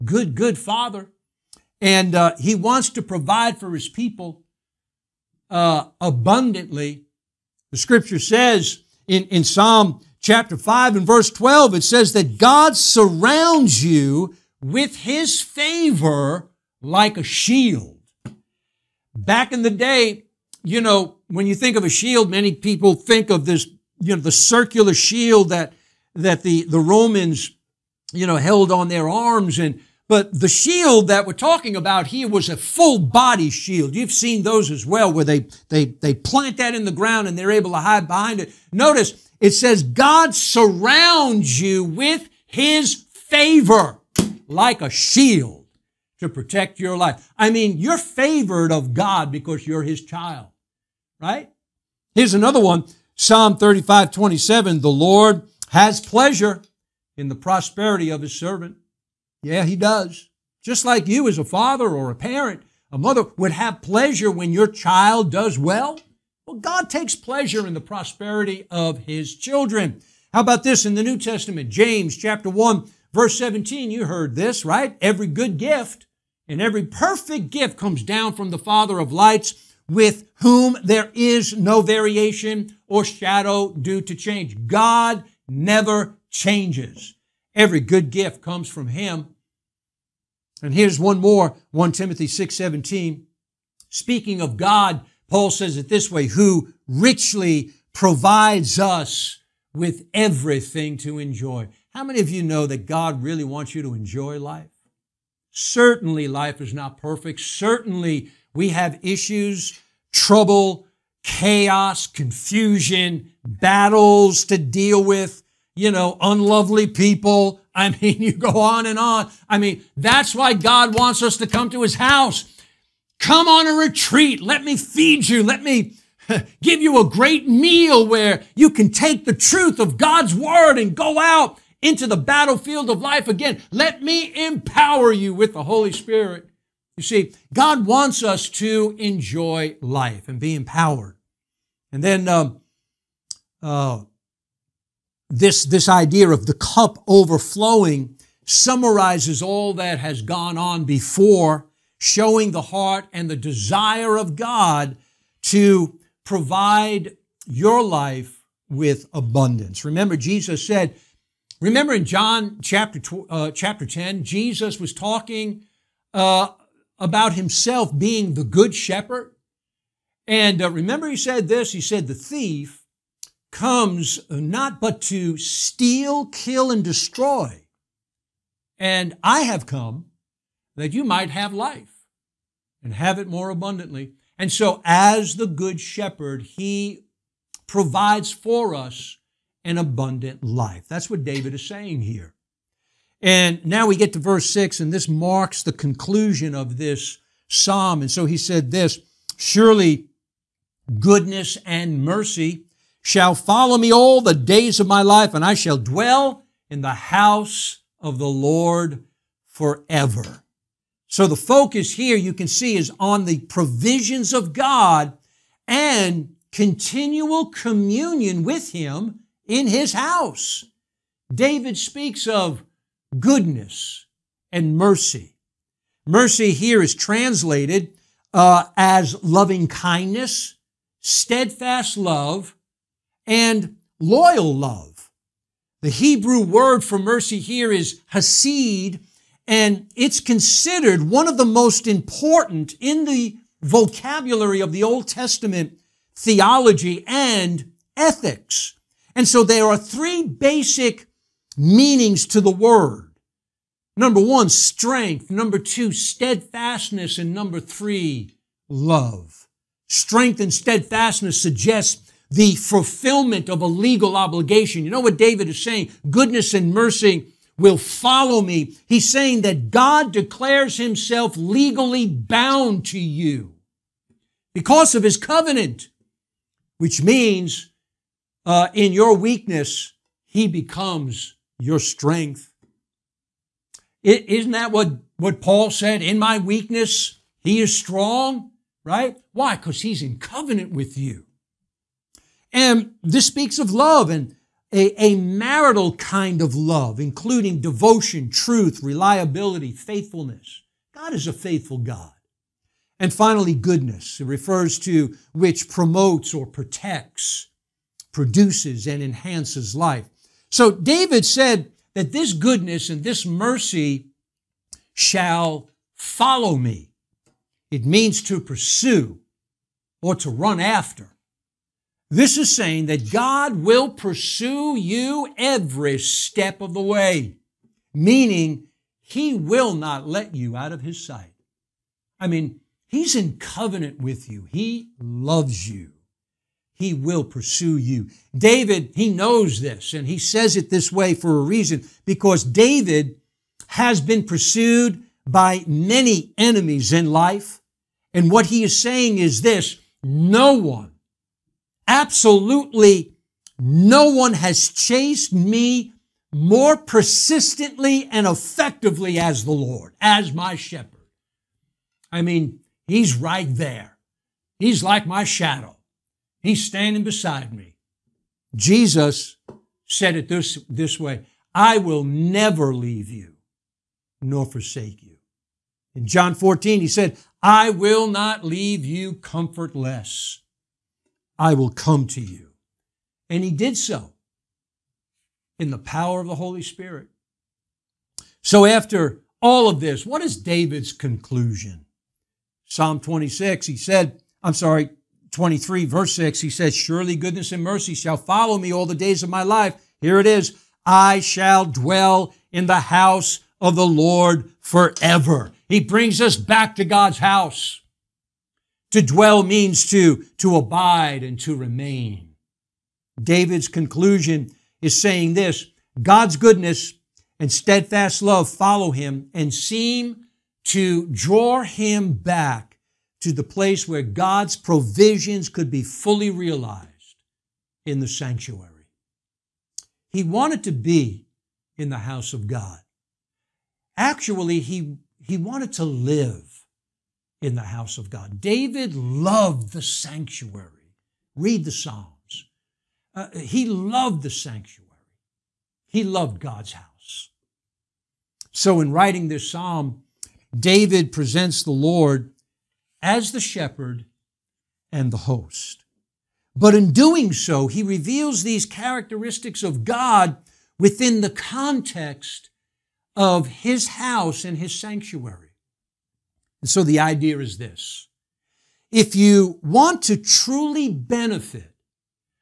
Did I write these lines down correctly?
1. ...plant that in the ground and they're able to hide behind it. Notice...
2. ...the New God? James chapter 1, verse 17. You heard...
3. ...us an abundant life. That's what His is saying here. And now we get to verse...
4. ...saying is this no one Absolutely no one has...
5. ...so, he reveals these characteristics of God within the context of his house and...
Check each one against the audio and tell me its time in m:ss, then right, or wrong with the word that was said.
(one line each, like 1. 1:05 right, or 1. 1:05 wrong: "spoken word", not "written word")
1. 0:36 right
2. 1:10 wrong: "Testament", not "God"
3. 3:08 wrong: "David", not "His"
4. 5:48 right
5. 7:37 right.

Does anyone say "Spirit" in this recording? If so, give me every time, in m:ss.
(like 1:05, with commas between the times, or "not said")
2:15, 6:26.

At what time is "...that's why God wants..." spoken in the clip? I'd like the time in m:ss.
1:59.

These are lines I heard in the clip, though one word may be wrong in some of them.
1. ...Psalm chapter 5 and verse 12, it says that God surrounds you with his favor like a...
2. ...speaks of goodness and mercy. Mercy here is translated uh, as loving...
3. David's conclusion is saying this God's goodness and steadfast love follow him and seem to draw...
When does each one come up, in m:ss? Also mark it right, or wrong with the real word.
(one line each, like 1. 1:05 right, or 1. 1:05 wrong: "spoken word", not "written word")
1. 0:09 right
2. 3:41 right
3. 6:53 right.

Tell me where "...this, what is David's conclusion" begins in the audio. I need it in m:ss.
6:29.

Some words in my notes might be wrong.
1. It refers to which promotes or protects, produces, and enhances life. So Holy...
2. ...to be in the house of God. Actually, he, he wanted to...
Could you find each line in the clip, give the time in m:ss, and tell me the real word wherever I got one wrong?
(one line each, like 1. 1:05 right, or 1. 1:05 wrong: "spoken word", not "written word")
1. 5:04 wrong: "David", not "Holy"
2. 7:10 right.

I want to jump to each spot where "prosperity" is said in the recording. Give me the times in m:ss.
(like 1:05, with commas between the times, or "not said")
0:57, 1:07.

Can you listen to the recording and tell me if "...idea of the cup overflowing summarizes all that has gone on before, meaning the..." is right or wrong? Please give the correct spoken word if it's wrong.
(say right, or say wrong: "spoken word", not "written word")
wrong: "showing", not "meaning".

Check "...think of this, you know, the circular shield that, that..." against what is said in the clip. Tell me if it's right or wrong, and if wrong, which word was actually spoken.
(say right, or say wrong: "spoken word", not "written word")
right.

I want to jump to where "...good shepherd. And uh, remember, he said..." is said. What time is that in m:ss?
2:48.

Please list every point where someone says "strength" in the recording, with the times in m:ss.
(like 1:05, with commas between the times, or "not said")
4:14, 4:19, 4:41.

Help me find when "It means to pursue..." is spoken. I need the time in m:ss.
5:17.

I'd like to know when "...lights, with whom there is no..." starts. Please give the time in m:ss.
1:19.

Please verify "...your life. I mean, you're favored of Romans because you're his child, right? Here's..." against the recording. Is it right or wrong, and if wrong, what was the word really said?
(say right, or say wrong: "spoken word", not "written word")
wrong: "God", not "Romans".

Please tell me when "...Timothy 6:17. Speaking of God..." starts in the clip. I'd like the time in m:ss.
1:31.